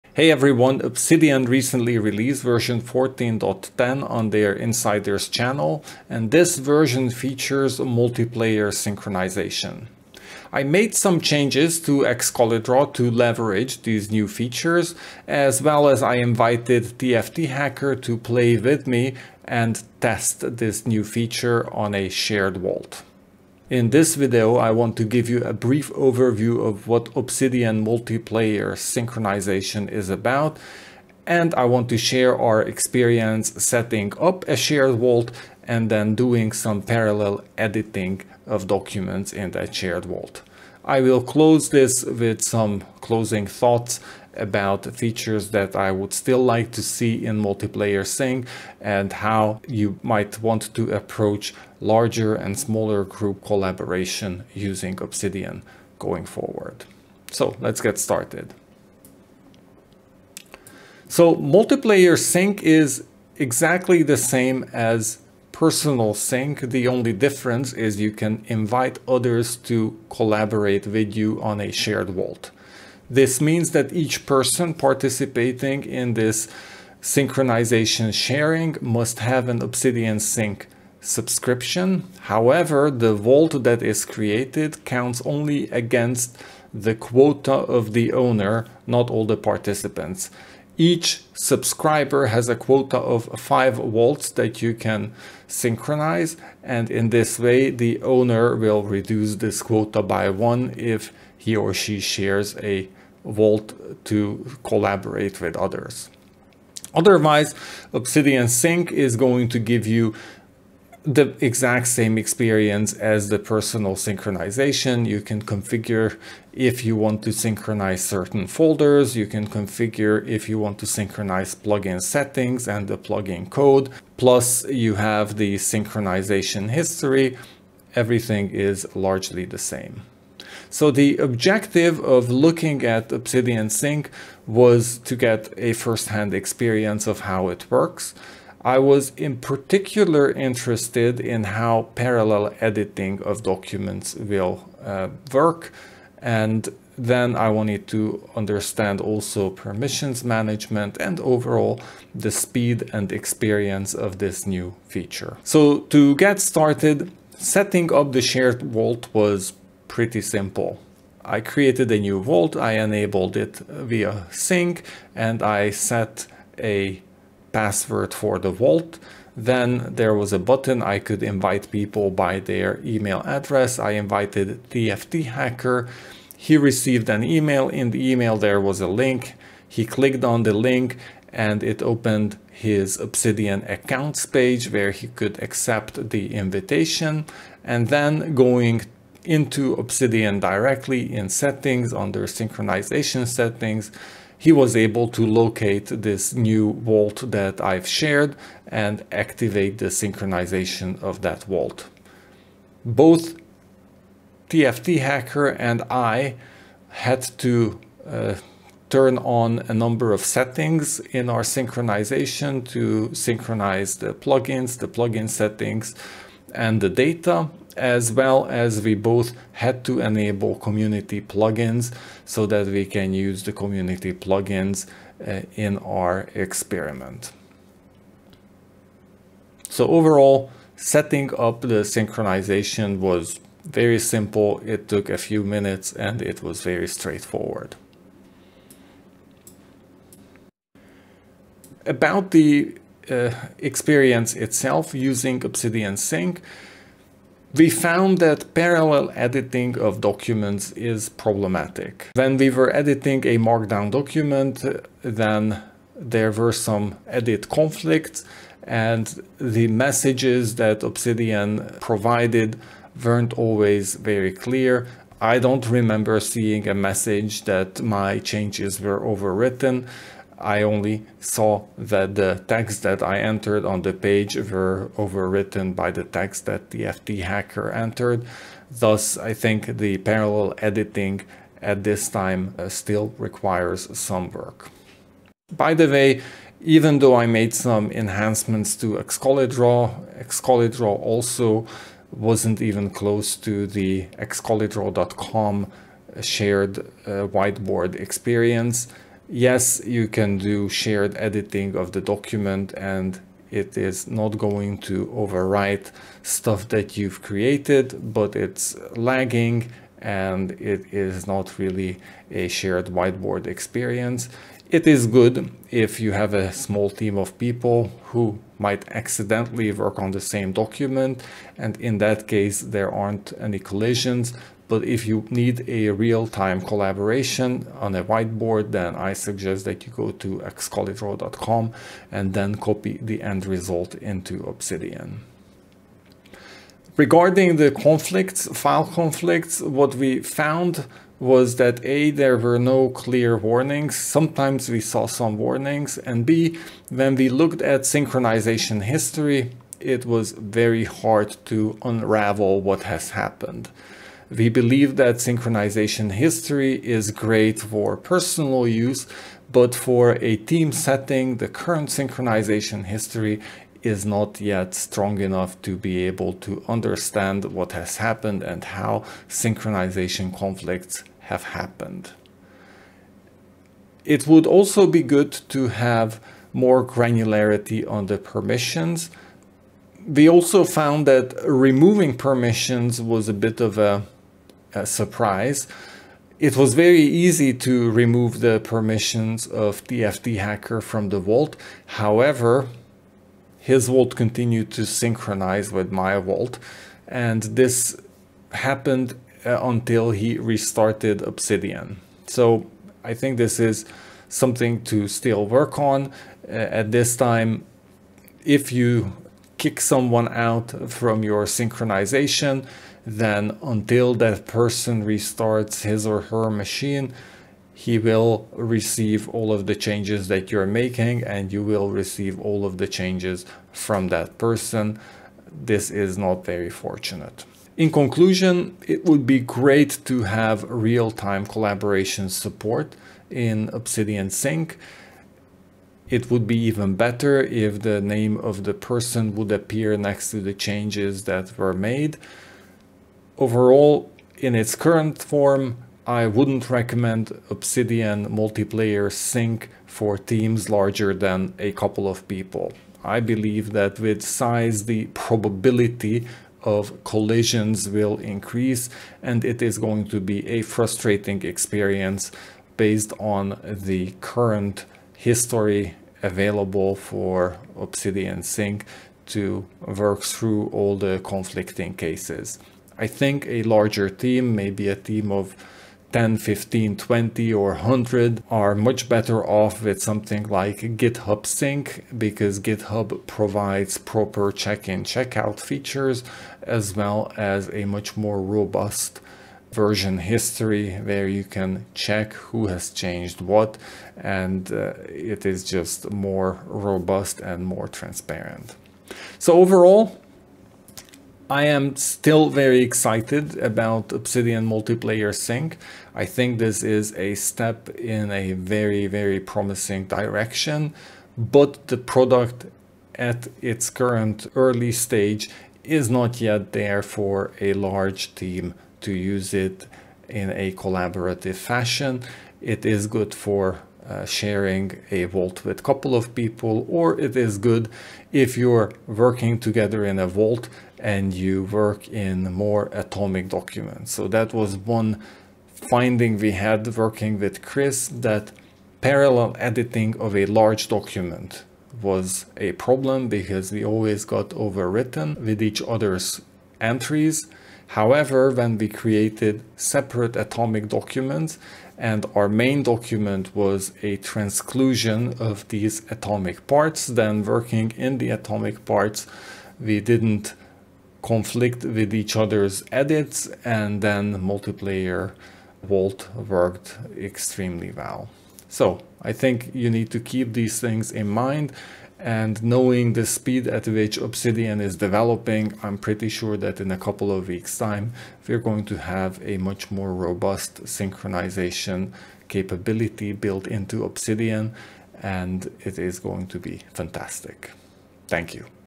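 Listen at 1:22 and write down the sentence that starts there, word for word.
However, the vault that is created counts only against the quota of the owner, not all the participants.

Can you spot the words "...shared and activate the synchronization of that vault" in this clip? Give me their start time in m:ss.
3:17.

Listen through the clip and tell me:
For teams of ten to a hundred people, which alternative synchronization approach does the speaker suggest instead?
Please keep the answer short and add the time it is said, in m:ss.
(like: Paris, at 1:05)
GitHub Sync, at 8:00.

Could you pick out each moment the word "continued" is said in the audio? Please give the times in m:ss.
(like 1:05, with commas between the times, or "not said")
6:34.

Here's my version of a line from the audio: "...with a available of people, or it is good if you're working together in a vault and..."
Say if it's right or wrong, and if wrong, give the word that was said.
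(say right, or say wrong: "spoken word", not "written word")
wrong: "couple", not "available".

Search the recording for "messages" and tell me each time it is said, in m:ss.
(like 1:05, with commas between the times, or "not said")
4:19, 4:26.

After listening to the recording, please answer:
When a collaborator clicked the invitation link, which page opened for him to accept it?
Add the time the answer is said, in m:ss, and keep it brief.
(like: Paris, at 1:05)
Obsidian accounts page, at 3:02.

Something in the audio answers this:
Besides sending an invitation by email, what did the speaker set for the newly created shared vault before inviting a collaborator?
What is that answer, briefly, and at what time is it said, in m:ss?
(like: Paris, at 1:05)
A password, at 2:47.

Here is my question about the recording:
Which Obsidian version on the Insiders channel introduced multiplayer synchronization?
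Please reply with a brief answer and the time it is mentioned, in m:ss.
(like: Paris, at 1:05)
14.10, at 0:02.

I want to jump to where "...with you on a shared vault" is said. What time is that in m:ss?
1:10.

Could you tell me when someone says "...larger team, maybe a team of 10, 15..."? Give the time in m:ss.
7:53.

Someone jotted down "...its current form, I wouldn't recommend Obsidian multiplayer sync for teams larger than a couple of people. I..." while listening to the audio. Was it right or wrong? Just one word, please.
right.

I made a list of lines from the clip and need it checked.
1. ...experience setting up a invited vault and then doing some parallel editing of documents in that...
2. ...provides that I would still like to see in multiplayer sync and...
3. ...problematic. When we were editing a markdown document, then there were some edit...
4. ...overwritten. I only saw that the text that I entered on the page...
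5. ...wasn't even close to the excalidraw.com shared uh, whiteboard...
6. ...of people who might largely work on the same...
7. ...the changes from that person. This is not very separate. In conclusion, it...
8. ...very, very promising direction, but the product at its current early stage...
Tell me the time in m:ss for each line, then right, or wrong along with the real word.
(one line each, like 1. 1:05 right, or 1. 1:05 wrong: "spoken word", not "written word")
1. 0:32 wrong: "shared", not "invited"
2. 0:44 wrong: "features", not "provides"
3. 4:11 right
4. 4:29 right
5. 4:52 right
6. 5:17 wrong: "accidentally", not "largely"
7. 7:02 wrong: "fortunate", not "separate"
8. 8:28 right.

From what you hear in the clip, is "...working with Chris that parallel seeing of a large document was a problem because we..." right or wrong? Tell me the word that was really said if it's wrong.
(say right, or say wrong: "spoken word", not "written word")
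wrong: "editing", not "seeing".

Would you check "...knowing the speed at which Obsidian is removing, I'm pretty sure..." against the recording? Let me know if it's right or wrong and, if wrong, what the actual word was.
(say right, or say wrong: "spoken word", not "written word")
wrong: "developing", not "removing".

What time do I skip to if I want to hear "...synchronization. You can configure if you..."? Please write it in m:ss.
1:53.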